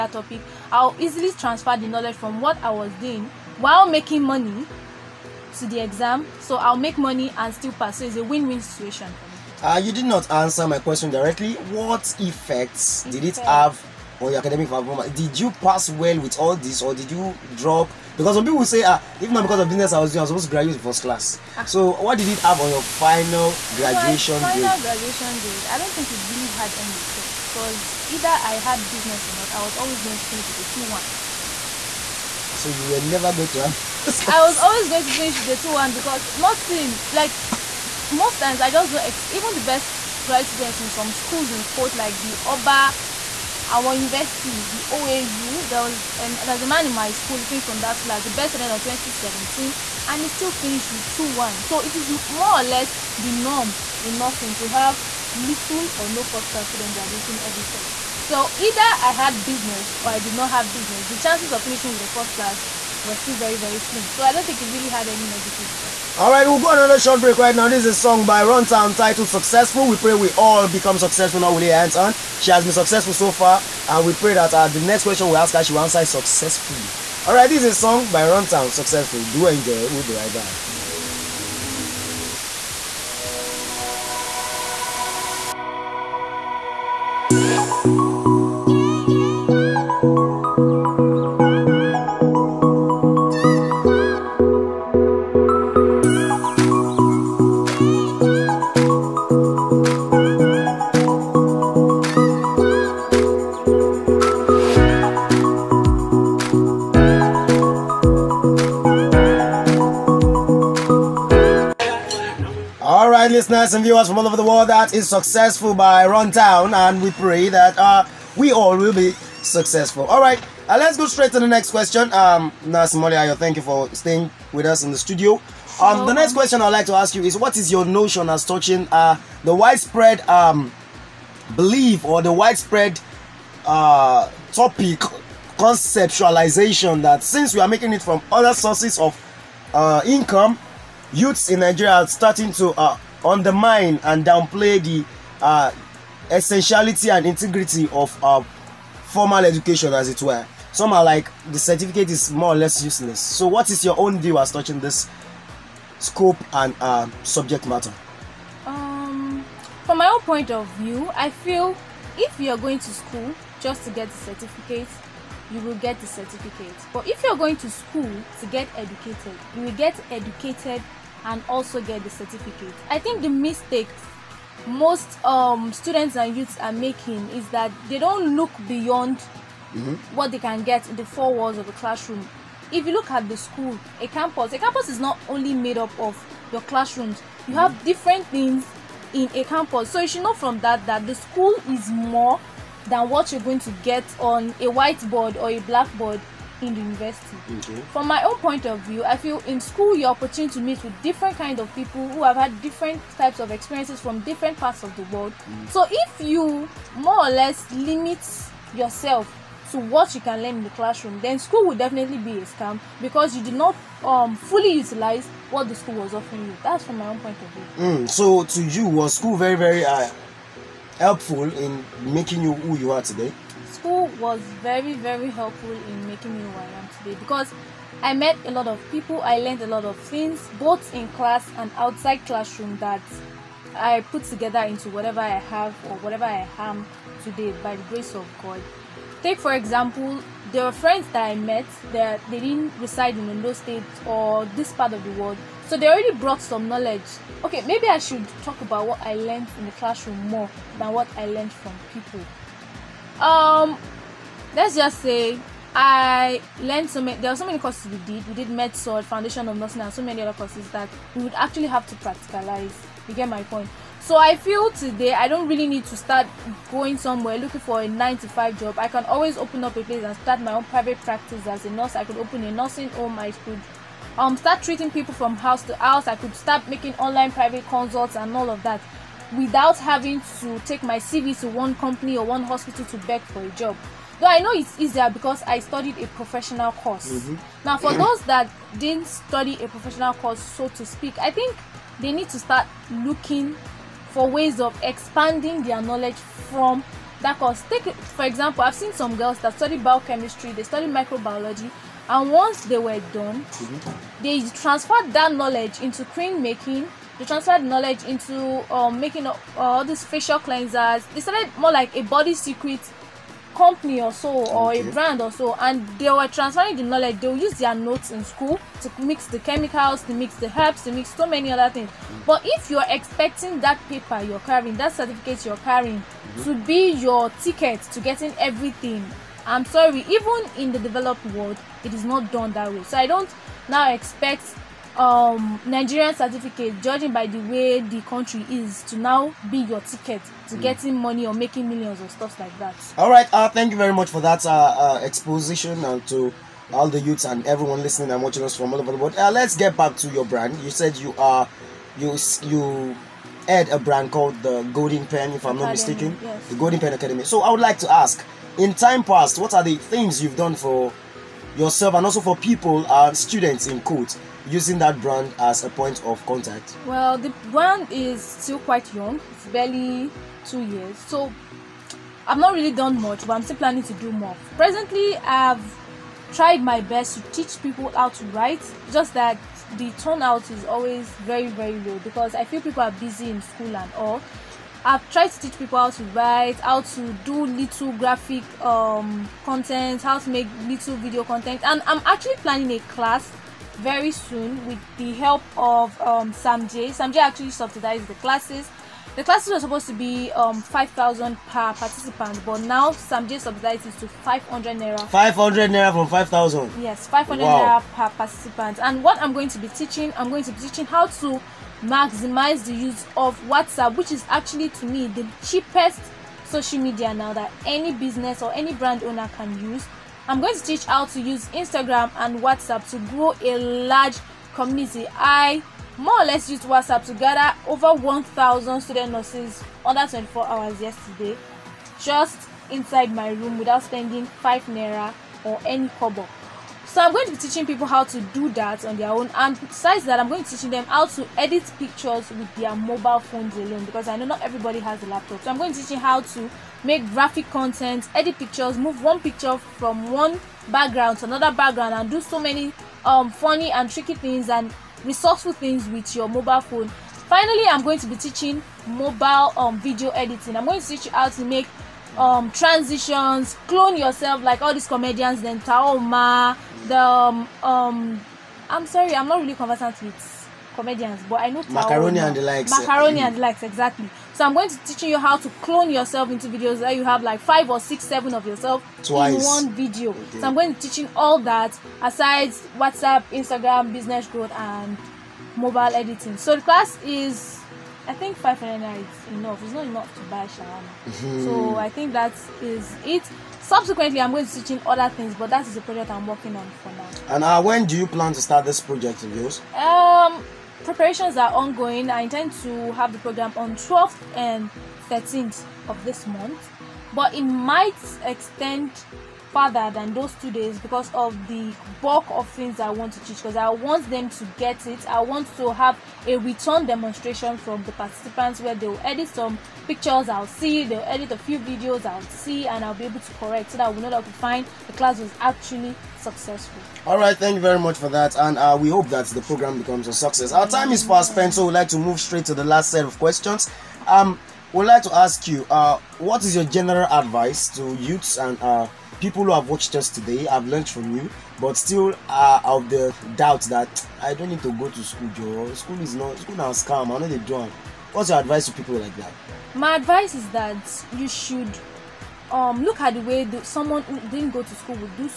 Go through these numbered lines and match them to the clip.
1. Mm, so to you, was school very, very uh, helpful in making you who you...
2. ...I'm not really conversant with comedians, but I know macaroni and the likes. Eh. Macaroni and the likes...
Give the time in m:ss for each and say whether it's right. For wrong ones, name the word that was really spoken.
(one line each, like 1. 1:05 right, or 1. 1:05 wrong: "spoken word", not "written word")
1. 3:37 right
2. 7:49 right.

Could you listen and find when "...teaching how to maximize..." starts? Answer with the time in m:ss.
6:50.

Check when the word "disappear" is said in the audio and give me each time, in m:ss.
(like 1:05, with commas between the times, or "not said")
not said.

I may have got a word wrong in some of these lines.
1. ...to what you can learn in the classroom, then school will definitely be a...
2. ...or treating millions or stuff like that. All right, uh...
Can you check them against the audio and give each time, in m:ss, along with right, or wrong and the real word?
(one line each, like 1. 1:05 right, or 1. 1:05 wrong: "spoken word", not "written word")
1. 3:29 right
2. 5:41 wrong: "making", not "treating".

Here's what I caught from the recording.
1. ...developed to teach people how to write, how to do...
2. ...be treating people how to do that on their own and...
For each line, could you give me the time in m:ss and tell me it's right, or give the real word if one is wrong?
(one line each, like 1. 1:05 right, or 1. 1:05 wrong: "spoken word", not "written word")
1. 6:25 wrong: "tried", not "developed"
2. 7:17 wrong: "teaching", not "treating".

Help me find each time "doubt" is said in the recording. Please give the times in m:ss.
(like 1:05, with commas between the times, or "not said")
9:03.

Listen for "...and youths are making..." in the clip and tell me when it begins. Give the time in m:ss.
2:56.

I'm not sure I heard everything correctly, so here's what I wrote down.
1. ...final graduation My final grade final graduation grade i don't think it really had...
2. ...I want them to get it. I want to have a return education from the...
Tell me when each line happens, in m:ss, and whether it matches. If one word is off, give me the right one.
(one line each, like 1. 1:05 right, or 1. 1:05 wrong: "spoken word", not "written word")
1. 0:22 right
2. 8:33 wrong: "demonstration", not "education".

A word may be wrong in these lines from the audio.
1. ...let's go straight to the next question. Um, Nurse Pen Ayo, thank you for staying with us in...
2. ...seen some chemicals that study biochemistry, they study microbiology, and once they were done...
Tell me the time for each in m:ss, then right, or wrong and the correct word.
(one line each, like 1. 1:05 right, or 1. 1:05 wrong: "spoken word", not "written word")
1. 2:00 wrong: "Molly", not "Pen"
2. 4:58 wrong: "girls", not "chemicals".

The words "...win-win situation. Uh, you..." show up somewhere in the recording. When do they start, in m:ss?
0:08.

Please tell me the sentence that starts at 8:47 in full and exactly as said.
All right, thank you very much for that, and uh, we hope that the program becomes a success.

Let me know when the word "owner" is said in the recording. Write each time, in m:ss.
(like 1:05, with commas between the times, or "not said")
6:59.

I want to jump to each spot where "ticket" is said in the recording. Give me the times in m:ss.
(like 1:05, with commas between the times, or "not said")
5:27, 5:39.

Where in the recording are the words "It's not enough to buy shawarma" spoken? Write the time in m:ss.
8:09.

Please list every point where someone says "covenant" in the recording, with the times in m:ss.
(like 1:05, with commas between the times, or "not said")
not said.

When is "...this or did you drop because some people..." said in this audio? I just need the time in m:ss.
0:16.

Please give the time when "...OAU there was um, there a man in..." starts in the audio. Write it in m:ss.
0:44.